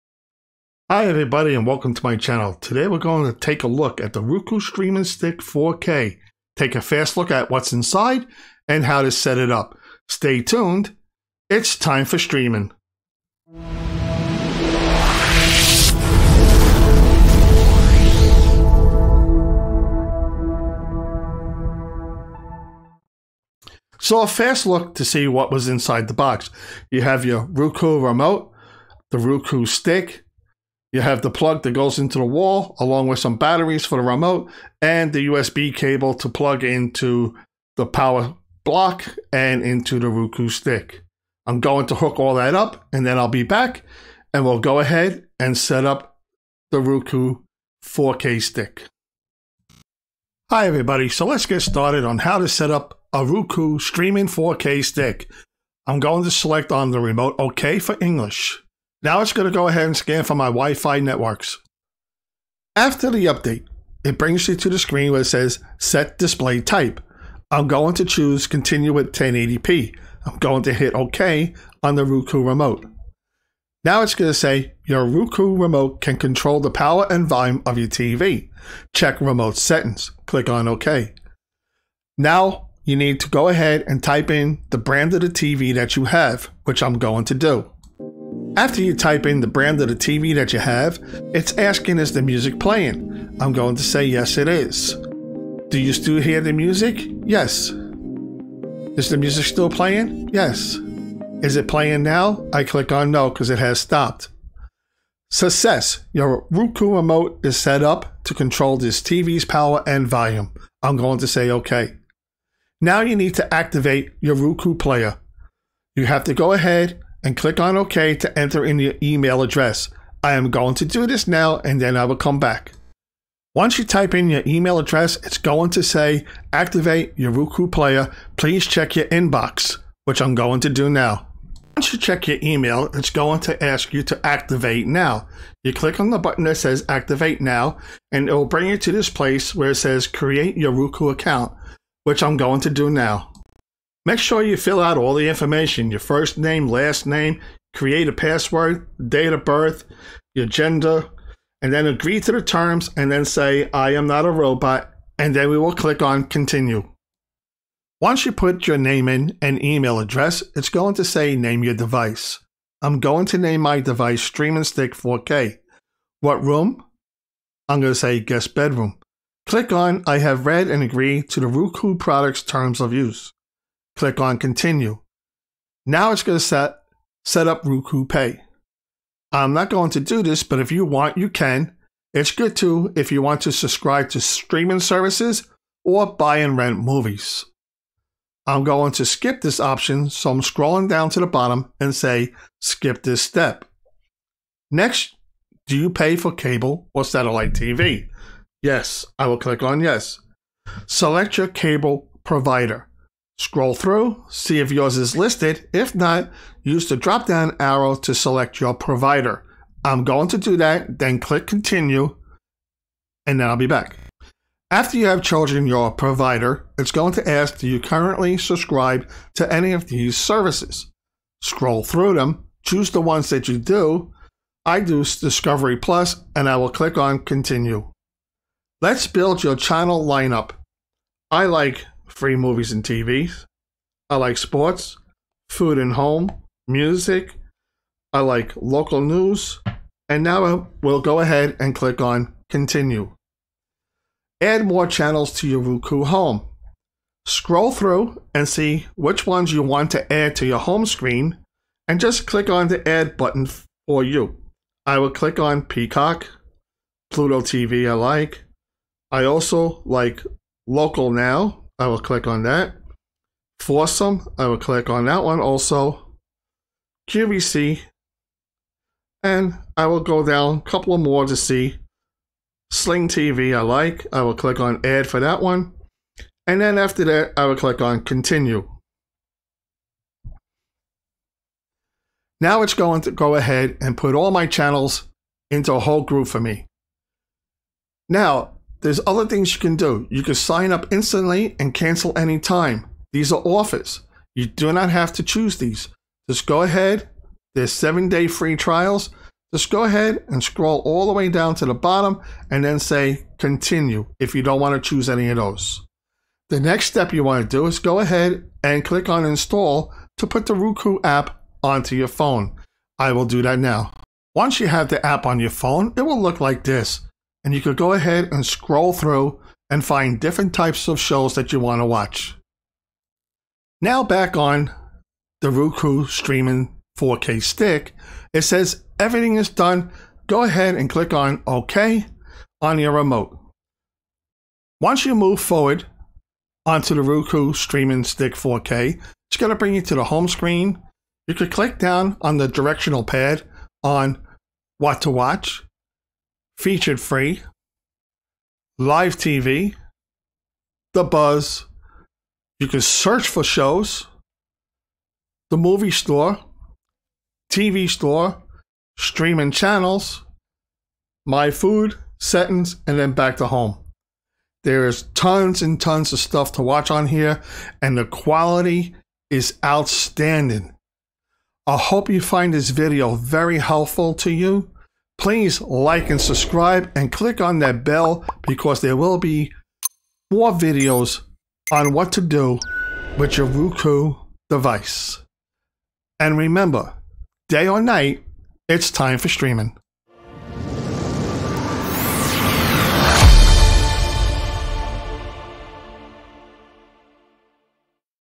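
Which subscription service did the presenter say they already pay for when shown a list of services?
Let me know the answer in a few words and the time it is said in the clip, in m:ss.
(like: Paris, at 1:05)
Discovery Plus, at 3:45.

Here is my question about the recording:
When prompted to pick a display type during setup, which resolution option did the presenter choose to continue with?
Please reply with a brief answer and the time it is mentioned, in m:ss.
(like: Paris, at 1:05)
1080p, at 1:09.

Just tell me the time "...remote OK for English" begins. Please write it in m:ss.
0:56.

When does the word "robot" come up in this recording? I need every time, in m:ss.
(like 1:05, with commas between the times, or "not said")
2:34.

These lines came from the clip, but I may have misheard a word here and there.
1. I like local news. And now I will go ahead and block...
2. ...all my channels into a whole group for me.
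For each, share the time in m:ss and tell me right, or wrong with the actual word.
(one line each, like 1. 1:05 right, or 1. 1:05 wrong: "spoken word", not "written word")
1. 3:58 wrong: "click", not "block"
2. 4:44 right.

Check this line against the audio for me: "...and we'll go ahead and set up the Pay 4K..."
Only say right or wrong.
wrong.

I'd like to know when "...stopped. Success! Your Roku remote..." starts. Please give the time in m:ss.
1:43.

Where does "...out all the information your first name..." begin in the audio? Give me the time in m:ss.
2:24.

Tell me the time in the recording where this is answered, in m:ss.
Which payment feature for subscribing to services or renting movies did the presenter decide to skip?
2:57.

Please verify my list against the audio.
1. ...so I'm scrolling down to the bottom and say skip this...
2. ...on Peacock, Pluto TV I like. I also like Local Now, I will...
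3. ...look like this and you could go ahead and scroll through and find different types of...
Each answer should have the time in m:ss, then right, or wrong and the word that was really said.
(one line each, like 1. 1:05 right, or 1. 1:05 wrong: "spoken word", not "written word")
1. 3:10 right
2. 4:15 right
3. 5:16 right.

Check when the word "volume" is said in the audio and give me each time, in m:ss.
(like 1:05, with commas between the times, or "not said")
1:17, 1:50.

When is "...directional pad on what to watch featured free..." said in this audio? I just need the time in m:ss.
5:42.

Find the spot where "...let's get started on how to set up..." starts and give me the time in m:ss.
0:51.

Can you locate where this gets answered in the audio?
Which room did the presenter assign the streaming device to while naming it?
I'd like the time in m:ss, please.
2:48.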